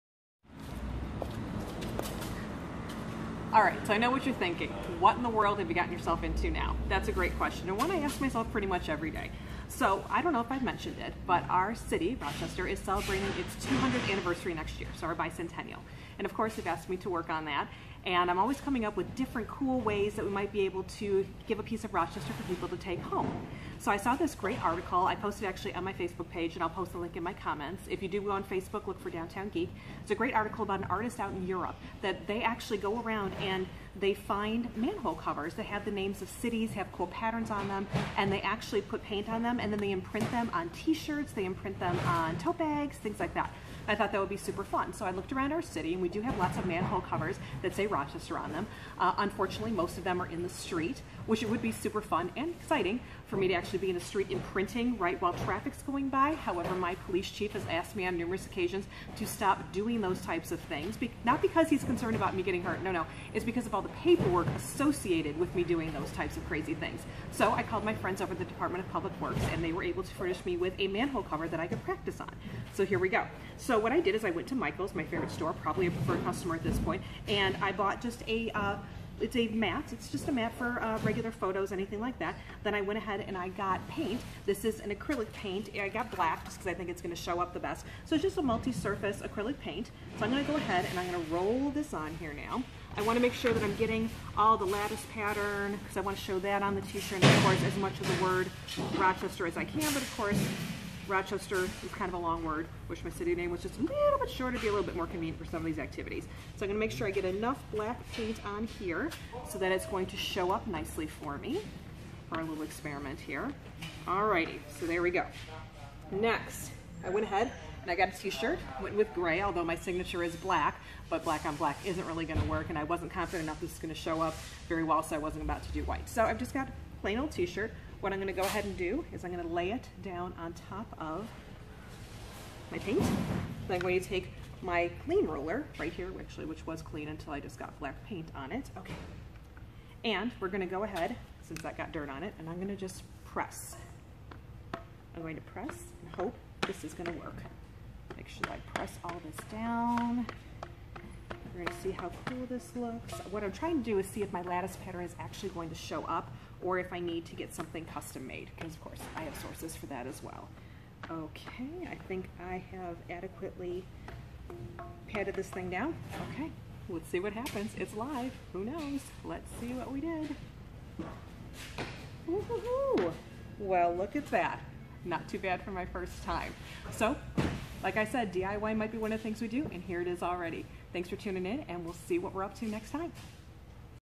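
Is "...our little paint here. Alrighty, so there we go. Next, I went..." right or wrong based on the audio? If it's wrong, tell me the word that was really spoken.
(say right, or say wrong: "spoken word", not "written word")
wrong: "experiment", not "paint".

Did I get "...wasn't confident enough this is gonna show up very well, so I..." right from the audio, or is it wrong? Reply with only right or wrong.
right.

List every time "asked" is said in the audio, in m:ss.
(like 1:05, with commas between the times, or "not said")
0:16, 0:57.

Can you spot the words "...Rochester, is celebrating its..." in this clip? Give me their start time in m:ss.
0:12.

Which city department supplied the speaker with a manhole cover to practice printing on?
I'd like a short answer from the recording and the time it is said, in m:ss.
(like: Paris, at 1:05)
Department of Public Works, at 1:08.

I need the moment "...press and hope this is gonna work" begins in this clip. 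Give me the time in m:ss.
2:25.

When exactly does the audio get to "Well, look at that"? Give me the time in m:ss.
2:53.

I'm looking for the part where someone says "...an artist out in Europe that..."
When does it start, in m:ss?
0:30.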